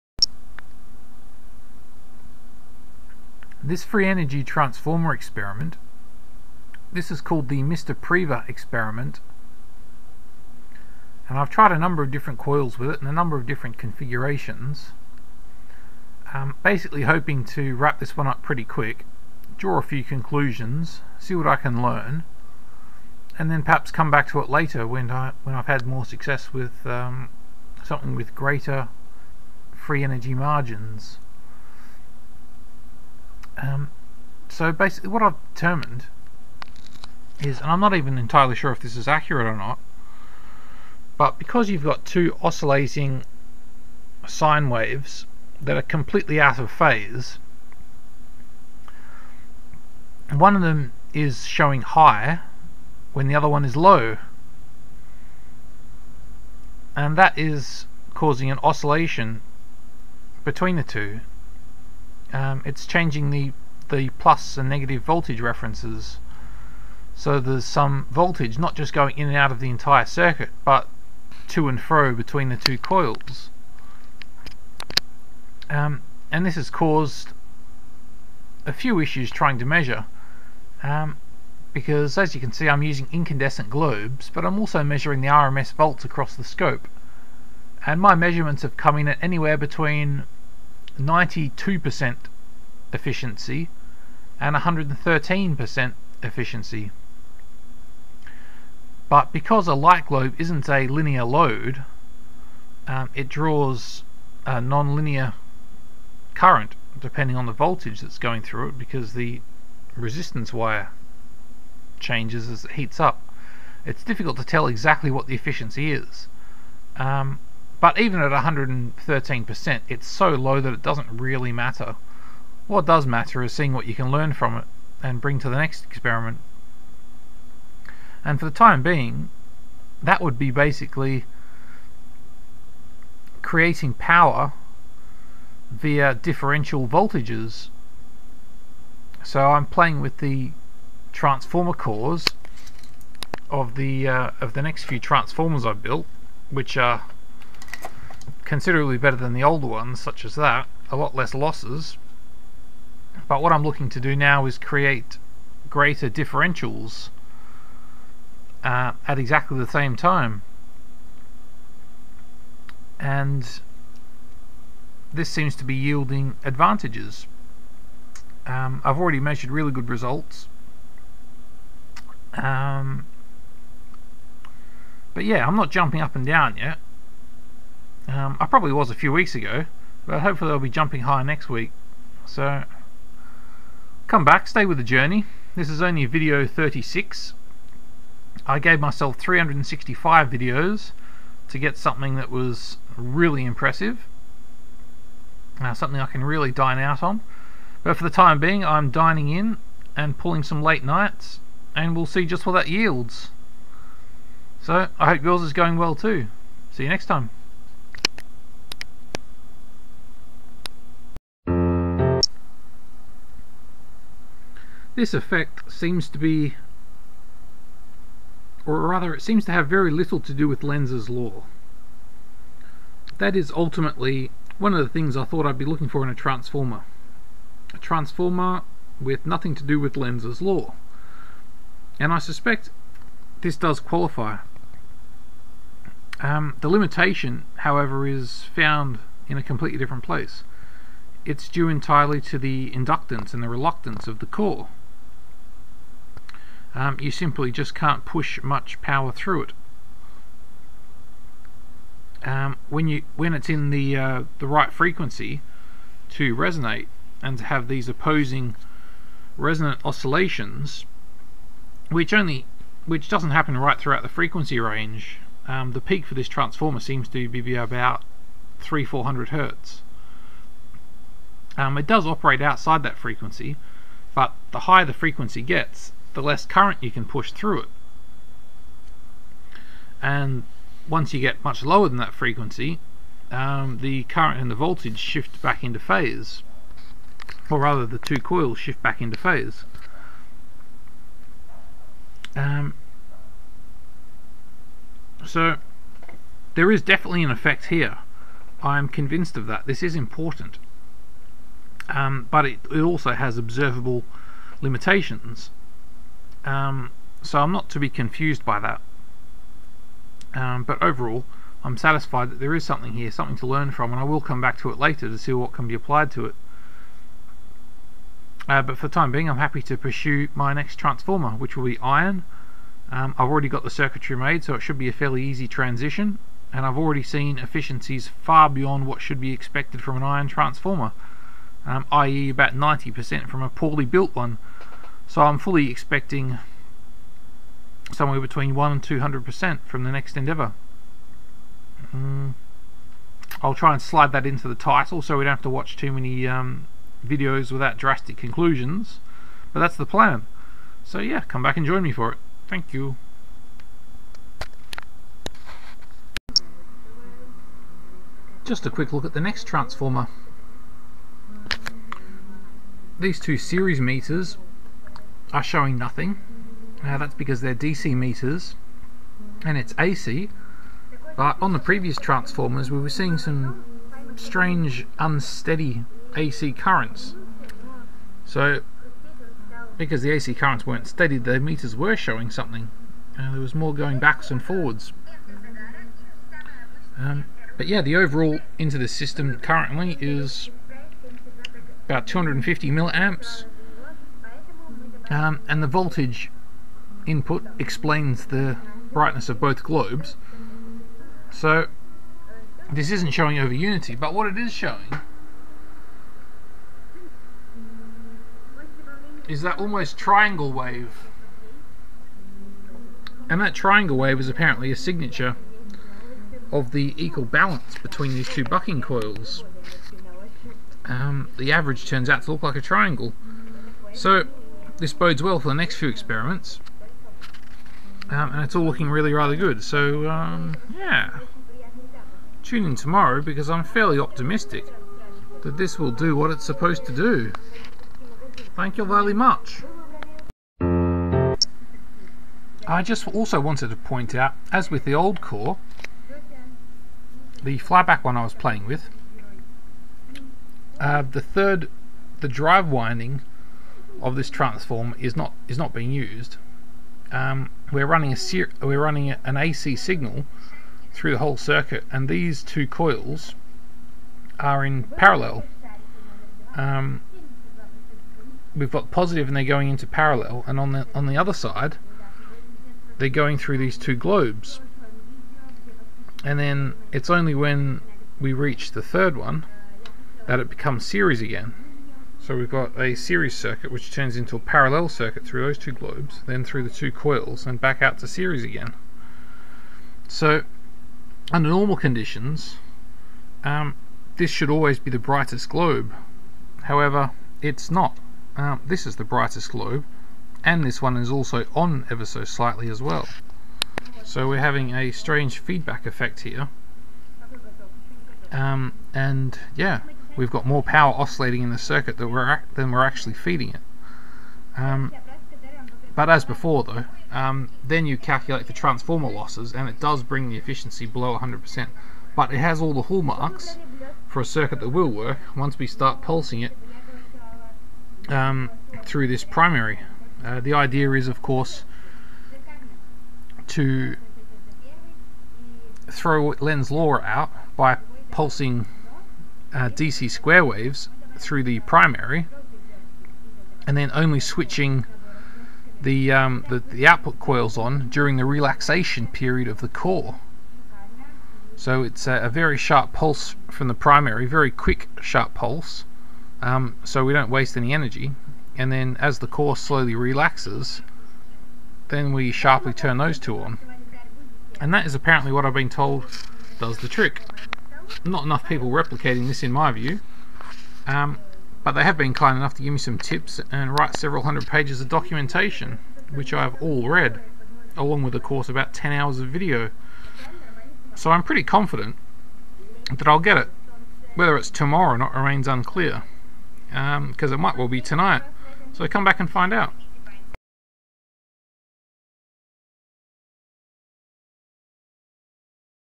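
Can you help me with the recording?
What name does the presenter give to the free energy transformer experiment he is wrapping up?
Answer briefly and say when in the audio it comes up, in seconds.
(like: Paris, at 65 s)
Mr. Preva experiment, at 7 s.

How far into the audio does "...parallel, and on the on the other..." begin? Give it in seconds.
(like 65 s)
469 s.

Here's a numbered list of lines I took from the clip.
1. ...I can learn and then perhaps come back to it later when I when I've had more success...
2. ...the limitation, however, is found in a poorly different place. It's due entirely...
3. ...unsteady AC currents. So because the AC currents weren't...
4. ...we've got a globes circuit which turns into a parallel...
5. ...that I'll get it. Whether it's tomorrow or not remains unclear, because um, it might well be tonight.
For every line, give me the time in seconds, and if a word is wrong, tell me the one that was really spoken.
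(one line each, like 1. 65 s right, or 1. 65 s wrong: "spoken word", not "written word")
1. 21 s right
2. 236 s wrong: "completely", not "poorly"
3. 374 s right
4. 482 s wrong: "series", not "globes"
5. 582 s right.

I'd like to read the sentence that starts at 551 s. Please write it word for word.
So it's a, a very sharp pulse from the primary, very quick sharp pulse, um, so we don't waste any energy.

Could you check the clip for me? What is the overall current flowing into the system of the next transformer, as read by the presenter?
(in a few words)
250 milliamps.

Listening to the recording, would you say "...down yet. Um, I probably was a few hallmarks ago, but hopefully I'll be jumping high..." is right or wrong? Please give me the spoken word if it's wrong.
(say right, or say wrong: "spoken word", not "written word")
wrong: "weeks", not "hallmarks".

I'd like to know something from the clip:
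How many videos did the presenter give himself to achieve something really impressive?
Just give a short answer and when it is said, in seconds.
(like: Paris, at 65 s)
365, at 189 s.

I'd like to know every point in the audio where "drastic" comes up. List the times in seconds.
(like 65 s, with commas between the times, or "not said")
347 s.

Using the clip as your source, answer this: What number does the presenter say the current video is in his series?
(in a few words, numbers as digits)
36.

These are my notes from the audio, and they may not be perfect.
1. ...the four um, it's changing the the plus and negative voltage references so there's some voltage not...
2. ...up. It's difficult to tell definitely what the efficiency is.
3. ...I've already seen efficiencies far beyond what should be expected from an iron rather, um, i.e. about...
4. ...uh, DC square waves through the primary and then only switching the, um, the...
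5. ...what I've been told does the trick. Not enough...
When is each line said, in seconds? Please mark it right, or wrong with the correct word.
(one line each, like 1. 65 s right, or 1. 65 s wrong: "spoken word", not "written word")
1. 60 s wrong: "two", not "four"
2. 112 s wrong: "exactly", not "definitely"
3. 326 s wrong: "transformer", not "rather"
4. 539 s right
5. 565 s right.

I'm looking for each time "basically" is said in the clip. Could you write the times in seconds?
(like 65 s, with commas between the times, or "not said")
16 s, 34 s, 130 s.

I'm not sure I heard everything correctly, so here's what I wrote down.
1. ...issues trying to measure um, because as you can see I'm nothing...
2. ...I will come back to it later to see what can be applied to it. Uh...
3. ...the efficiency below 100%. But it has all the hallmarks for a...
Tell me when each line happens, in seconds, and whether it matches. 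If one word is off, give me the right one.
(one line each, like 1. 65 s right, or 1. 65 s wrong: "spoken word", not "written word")
1. 78 s wrong: "using", not "nothing"
2. 313 s right
3. 520 s right.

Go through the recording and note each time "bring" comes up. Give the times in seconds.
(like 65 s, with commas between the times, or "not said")
125 s, 520 s.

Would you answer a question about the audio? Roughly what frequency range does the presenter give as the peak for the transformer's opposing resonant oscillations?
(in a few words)
300 to 400 hertz.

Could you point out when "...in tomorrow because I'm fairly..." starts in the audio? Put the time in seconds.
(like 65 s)
432 s.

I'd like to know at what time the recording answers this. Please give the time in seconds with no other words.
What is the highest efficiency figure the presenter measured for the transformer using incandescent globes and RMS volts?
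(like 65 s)
94 s.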